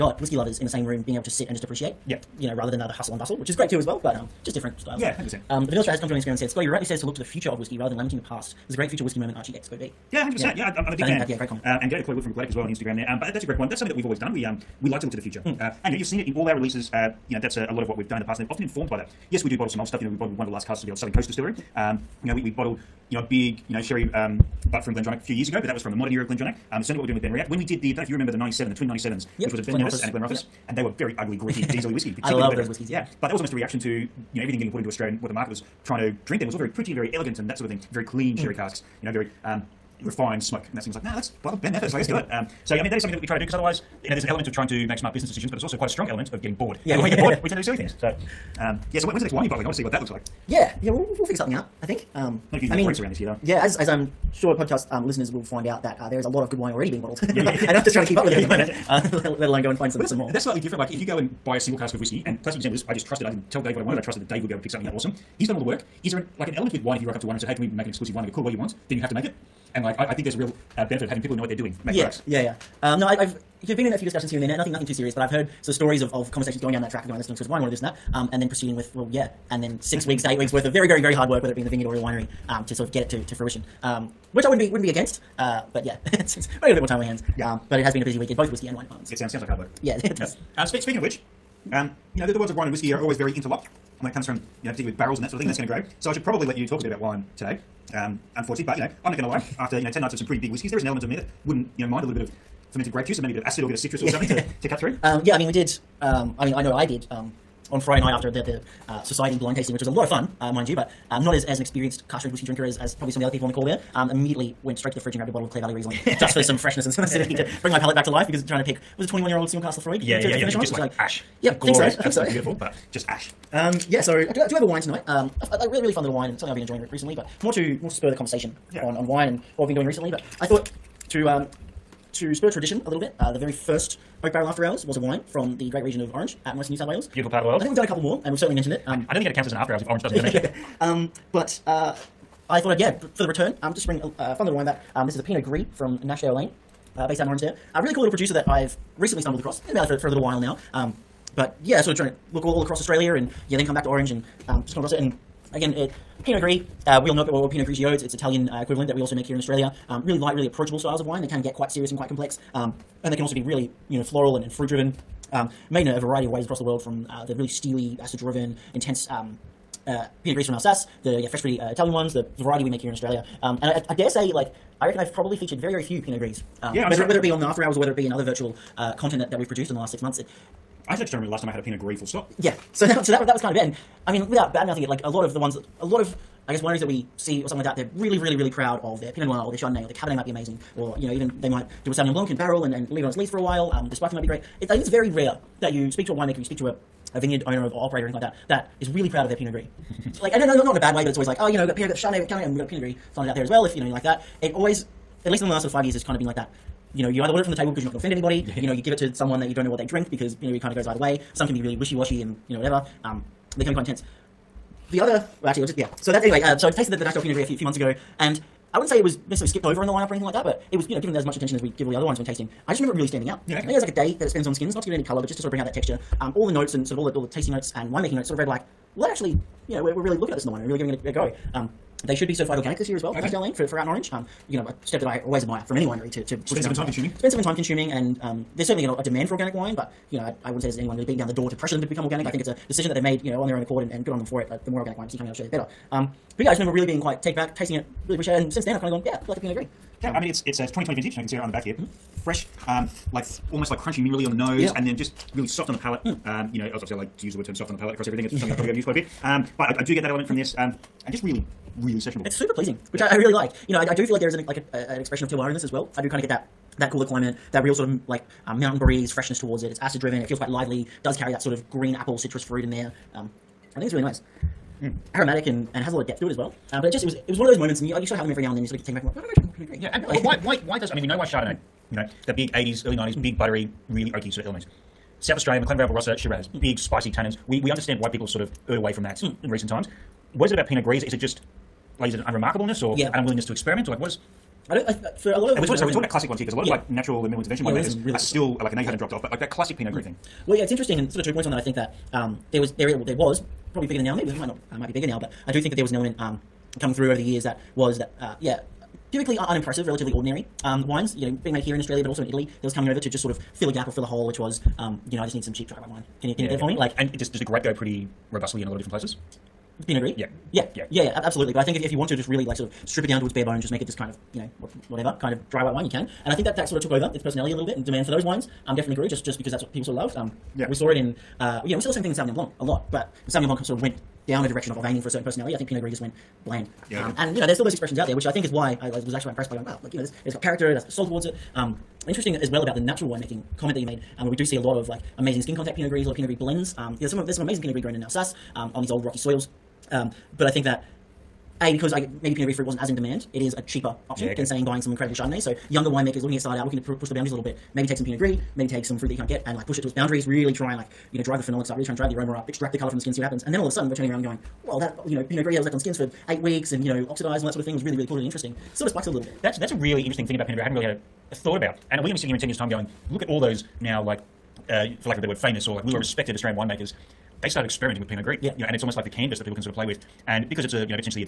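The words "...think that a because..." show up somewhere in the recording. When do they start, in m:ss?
5:50.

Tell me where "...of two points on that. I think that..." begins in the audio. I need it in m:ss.
5:01.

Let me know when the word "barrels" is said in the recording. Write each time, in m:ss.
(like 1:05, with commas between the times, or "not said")
1:34, 2:14, 3:12.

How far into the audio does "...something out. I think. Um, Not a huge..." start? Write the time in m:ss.
0:51.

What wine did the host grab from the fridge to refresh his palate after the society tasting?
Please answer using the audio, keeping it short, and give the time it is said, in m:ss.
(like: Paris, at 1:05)
Clare Valley Riesling, at 1:55.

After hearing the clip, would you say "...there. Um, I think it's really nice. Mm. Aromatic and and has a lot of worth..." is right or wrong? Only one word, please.
wrong.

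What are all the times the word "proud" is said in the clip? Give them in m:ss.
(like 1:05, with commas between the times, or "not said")
3:08, 3:19.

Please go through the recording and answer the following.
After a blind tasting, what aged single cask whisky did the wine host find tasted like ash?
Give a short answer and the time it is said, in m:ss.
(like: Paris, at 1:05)
21 year old Laphroaig, at 1:59.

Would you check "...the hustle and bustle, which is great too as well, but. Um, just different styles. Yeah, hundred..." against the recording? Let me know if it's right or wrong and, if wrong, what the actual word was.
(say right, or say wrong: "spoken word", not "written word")
right.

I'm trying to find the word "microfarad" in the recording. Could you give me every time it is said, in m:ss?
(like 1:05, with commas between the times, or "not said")
not said.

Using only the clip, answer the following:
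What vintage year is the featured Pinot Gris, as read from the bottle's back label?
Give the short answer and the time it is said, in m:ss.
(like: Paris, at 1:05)
2020, at 4:10.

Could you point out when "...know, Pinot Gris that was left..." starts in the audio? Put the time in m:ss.
6:05.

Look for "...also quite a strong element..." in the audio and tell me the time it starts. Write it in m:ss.
0:45.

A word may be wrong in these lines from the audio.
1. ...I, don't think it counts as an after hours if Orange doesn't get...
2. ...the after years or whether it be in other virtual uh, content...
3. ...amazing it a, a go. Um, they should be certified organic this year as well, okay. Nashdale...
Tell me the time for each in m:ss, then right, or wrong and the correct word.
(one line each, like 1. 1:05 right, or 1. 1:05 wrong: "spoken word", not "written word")
1. 2:19 right
2. 2:57 wrong: "hours", not "years"
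3. 3:50 wrong: "giving", not "amazing".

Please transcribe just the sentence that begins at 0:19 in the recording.
Yes, we do bottle some old stuff.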